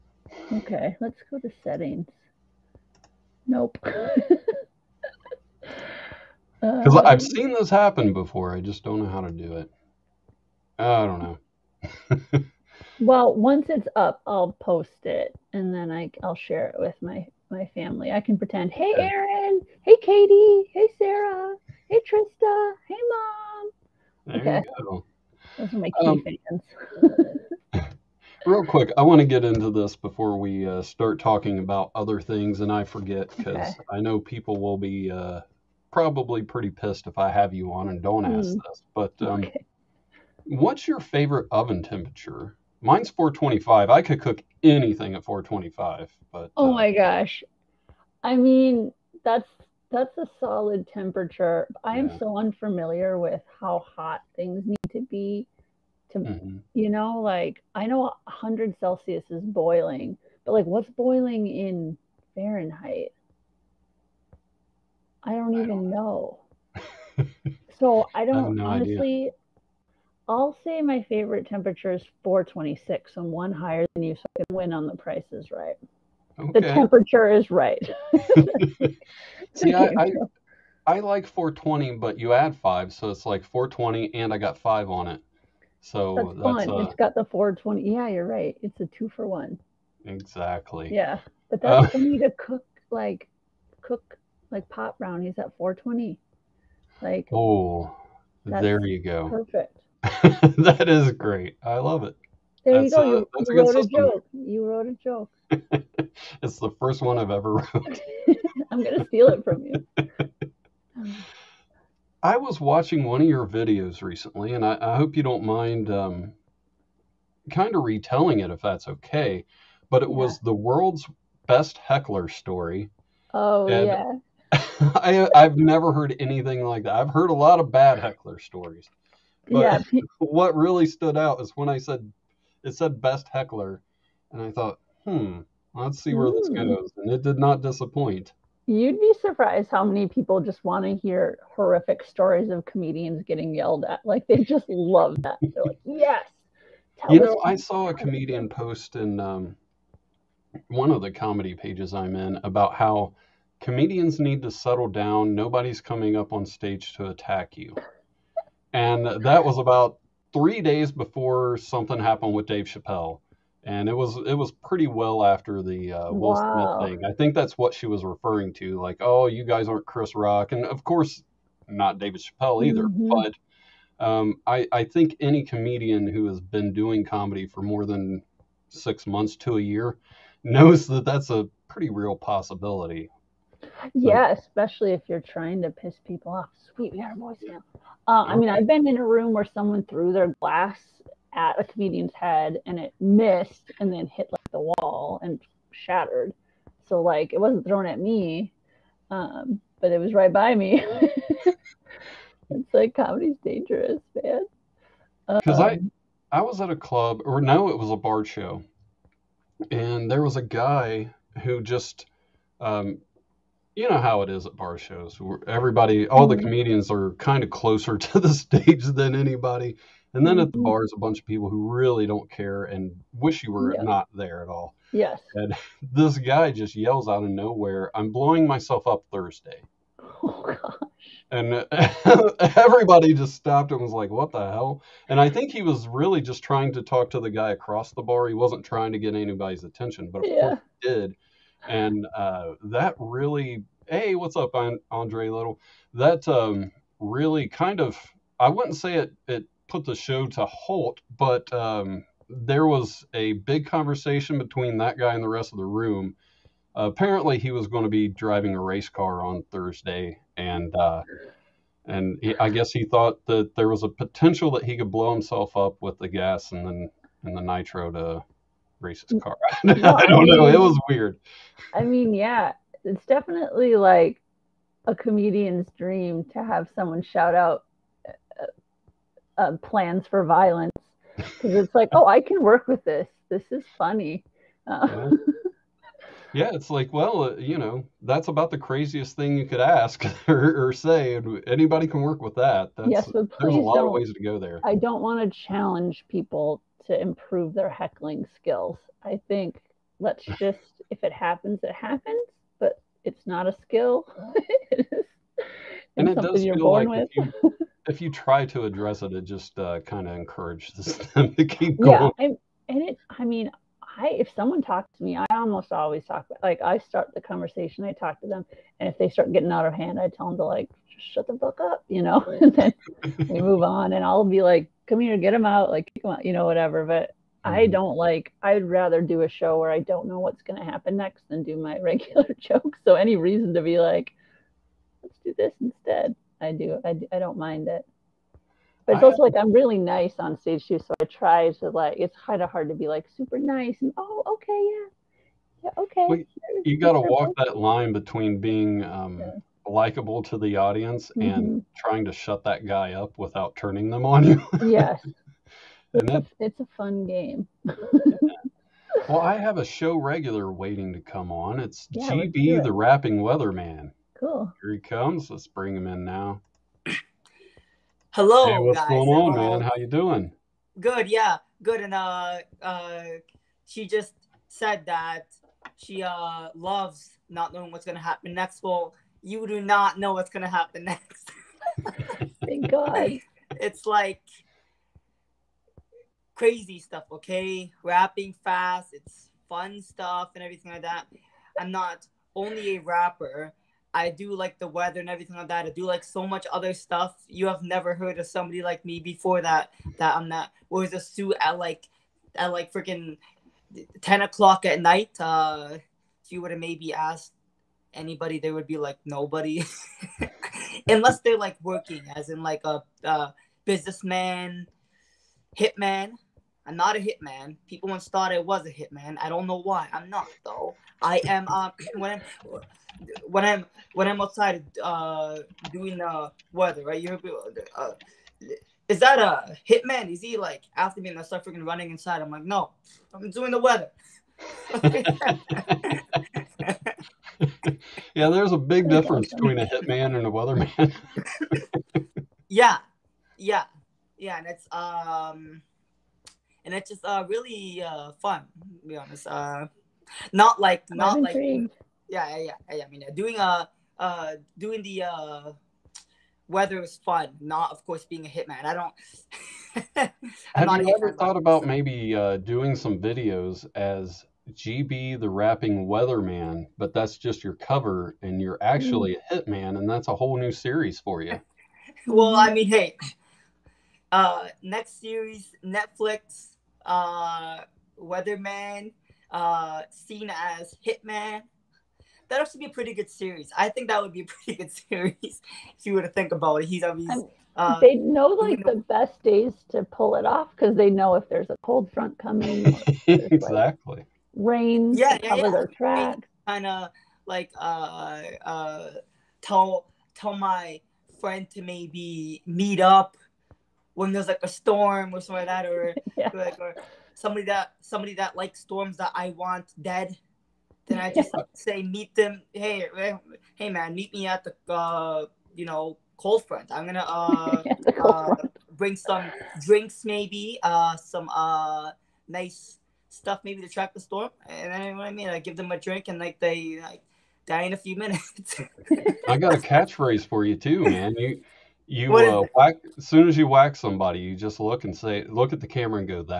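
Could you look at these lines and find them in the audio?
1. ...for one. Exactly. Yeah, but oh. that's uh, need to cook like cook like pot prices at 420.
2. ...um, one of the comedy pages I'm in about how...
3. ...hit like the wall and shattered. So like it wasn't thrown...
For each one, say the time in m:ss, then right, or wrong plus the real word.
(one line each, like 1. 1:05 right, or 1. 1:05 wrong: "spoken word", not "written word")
1. 1:29 wrong: "brownies", not "prices"
2. 2:29 right
3. 3:14 right.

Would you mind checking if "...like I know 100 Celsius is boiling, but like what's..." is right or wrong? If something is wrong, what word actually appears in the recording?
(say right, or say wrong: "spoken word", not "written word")
right.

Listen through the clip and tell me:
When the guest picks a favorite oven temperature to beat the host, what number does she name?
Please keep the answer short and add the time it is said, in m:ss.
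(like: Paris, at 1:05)
426, at 1:12.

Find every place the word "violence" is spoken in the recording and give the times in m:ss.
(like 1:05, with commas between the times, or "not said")
4:40.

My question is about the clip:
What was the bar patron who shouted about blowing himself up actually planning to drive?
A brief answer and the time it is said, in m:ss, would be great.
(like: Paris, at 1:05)
a race car, at 4:18.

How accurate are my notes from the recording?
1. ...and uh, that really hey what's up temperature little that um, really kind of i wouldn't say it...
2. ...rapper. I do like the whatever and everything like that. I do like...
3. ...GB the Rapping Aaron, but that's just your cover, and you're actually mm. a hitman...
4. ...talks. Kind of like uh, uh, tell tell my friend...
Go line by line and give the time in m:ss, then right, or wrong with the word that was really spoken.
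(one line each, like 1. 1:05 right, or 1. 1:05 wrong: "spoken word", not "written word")
1. 4:01 wrong: "andre", not "temperature"
2. 6:32 wrong: "weather", not "whatever"
3. 7:44 wrong: "Weatherman", not "Aaron"
4. 8:15 wrong: "tracks", not "talks".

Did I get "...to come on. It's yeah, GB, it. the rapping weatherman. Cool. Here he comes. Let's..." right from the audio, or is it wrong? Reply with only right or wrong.
right.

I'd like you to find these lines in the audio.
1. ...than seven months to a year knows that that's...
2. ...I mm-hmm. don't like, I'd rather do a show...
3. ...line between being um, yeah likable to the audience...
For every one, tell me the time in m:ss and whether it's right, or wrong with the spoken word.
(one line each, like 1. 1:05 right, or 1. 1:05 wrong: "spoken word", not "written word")
1. 2:57 wrong: "six", not "seven"
2. 5:27 right
3. 5:47 right.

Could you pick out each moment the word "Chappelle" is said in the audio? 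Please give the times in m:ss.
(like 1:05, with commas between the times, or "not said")
2:42, 2:52.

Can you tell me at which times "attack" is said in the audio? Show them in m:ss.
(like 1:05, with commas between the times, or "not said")
2:37.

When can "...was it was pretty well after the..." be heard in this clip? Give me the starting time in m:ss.
2:43.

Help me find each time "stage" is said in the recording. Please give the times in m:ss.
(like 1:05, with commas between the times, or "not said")
2:36, 3:38, 5:40.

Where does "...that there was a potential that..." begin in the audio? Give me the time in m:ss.
4:23.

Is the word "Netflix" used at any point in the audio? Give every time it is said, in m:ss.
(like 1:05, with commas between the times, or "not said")
7:55.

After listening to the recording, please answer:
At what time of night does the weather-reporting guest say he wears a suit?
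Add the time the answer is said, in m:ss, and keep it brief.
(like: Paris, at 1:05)
10 o'clock, at 6:44.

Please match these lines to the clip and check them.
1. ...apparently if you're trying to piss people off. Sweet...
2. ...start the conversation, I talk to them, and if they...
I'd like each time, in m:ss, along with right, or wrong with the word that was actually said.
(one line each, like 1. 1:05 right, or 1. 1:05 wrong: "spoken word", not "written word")
1. 3:04 wrong: "especially", not "apparently"
2. 5:16 right.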